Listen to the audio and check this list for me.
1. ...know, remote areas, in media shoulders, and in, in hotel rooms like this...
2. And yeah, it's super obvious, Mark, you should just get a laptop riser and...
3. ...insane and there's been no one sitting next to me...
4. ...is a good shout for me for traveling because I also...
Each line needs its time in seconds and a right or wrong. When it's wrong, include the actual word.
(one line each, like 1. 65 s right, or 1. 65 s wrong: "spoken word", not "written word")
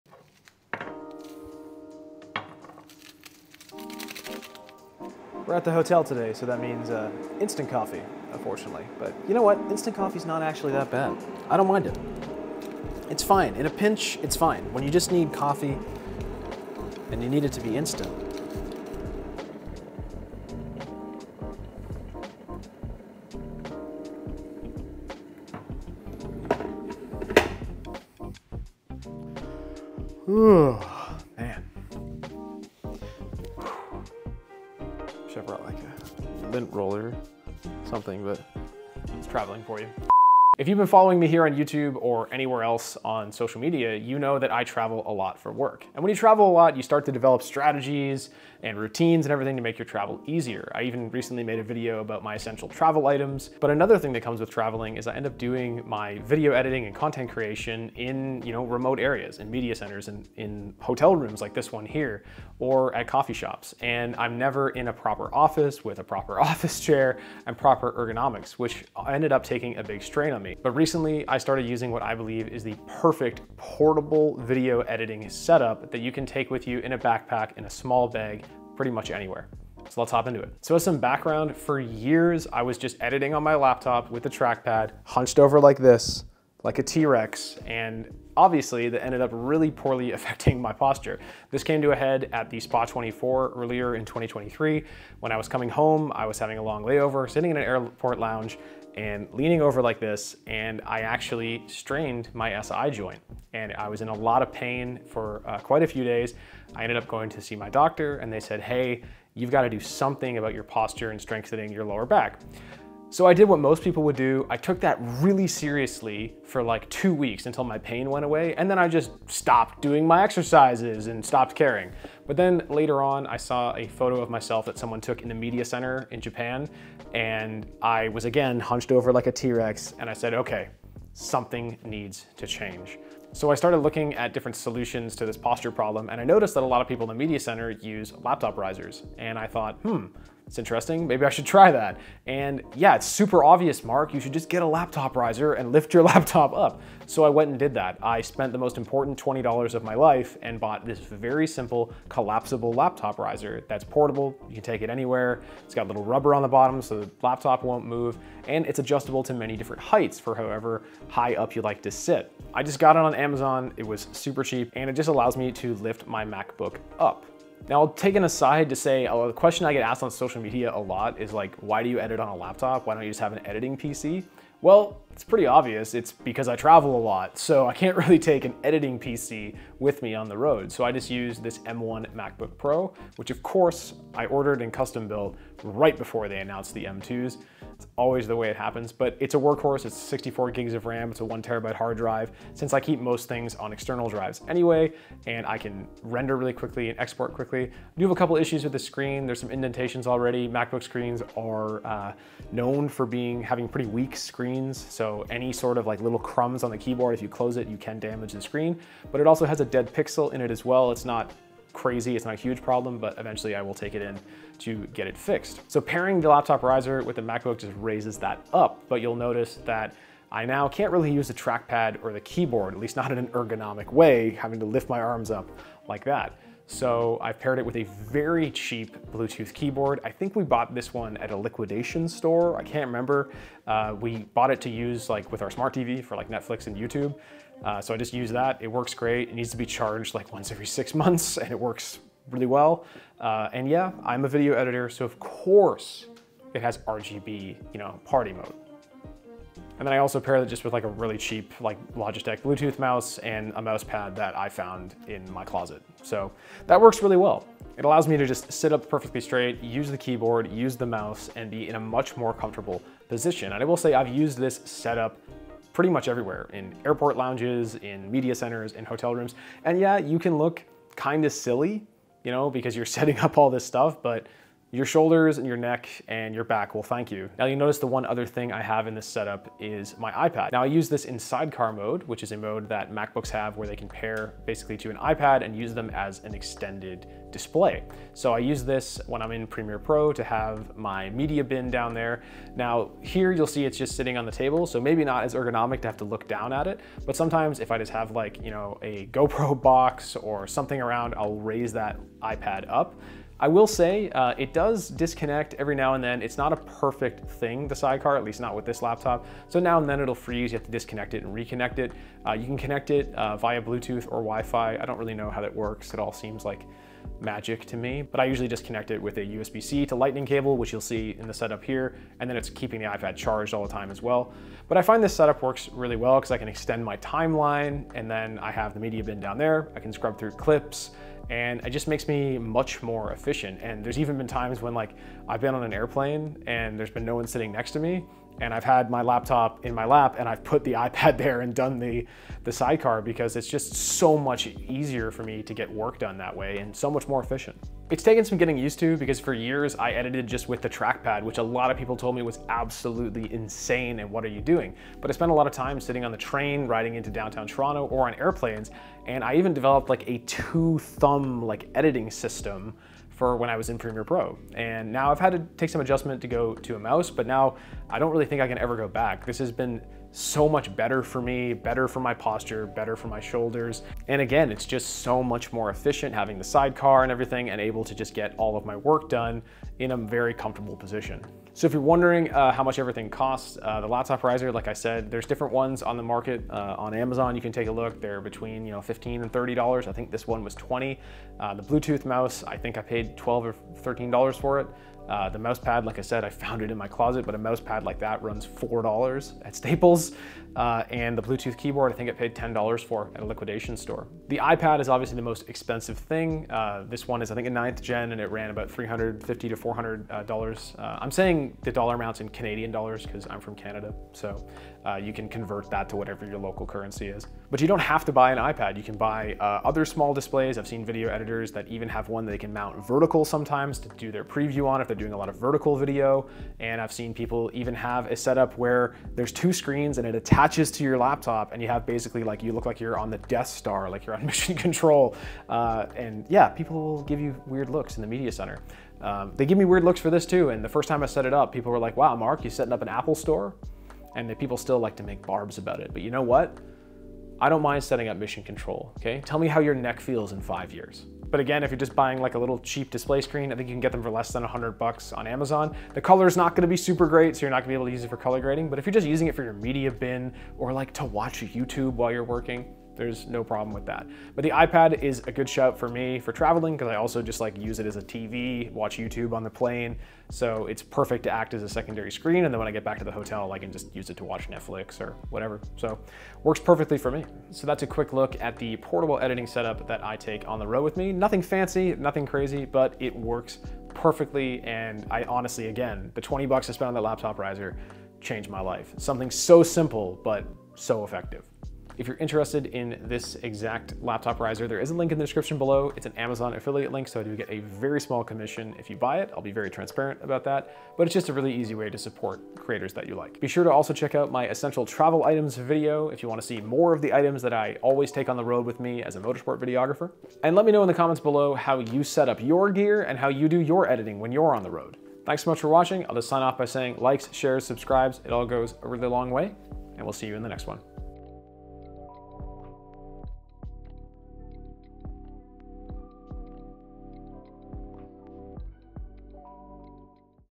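1. 58 s wrong: "centers", not "shoulders"
2. 142 s right
3. 335 s wrong: "airplane", not "insane"
4. 465 s right.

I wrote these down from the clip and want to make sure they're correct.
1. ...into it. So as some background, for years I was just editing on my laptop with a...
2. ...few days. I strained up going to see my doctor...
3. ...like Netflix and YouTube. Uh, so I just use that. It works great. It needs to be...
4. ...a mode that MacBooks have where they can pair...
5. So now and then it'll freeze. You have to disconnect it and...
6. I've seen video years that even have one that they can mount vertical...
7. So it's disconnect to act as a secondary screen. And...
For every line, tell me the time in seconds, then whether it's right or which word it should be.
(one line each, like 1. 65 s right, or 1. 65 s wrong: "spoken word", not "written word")
1. 80 s right
2. 105 s wrong: "ended", not "strained"
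3. 236 s right
4. 282 s right
5. 309 s right
6. 420 s wrong: "editors", not "years"
7. 470 s wrong: "perfect", not "disconnect".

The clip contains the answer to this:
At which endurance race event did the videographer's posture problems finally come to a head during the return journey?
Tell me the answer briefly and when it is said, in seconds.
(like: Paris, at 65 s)
Spa 24, at 92 s.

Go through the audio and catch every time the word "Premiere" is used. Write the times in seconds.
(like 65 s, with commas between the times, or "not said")
289 s, 363 s.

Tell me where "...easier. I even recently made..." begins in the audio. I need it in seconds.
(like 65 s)
50 s.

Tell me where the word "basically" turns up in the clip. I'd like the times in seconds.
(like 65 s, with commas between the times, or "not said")
284 s, 431 s.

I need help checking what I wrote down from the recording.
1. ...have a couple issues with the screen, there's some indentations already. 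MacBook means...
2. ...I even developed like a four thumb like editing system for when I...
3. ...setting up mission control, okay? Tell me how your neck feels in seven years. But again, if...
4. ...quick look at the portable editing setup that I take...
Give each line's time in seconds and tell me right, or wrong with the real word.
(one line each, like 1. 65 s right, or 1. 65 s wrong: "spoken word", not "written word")
1. 198 s wrong: "screens", not "means"
2. 359 s wrong: "two", not "four"
3. 447 s wrong: "five", not "seven"
4. 477 s right.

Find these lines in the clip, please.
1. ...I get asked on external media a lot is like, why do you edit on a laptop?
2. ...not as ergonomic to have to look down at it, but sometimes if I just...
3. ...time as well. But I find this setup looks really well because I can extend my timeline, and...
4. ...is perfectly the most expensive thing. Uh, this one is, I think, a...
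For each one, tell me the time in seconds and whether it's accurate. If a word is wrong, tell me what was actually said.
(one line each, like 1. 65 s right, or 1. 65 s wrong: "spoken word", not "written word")
1. 169 s wrong: "social", not "external"
2. 295 s right
3. 323 s wrong: "works", not "looks"
4. 404 s wrong: "obviously", not "perfectly".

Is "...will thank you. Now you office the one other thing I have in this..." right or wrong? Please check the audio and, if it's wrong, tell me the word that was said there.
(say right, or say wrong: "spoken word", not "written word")
wrong: "notice", not "office".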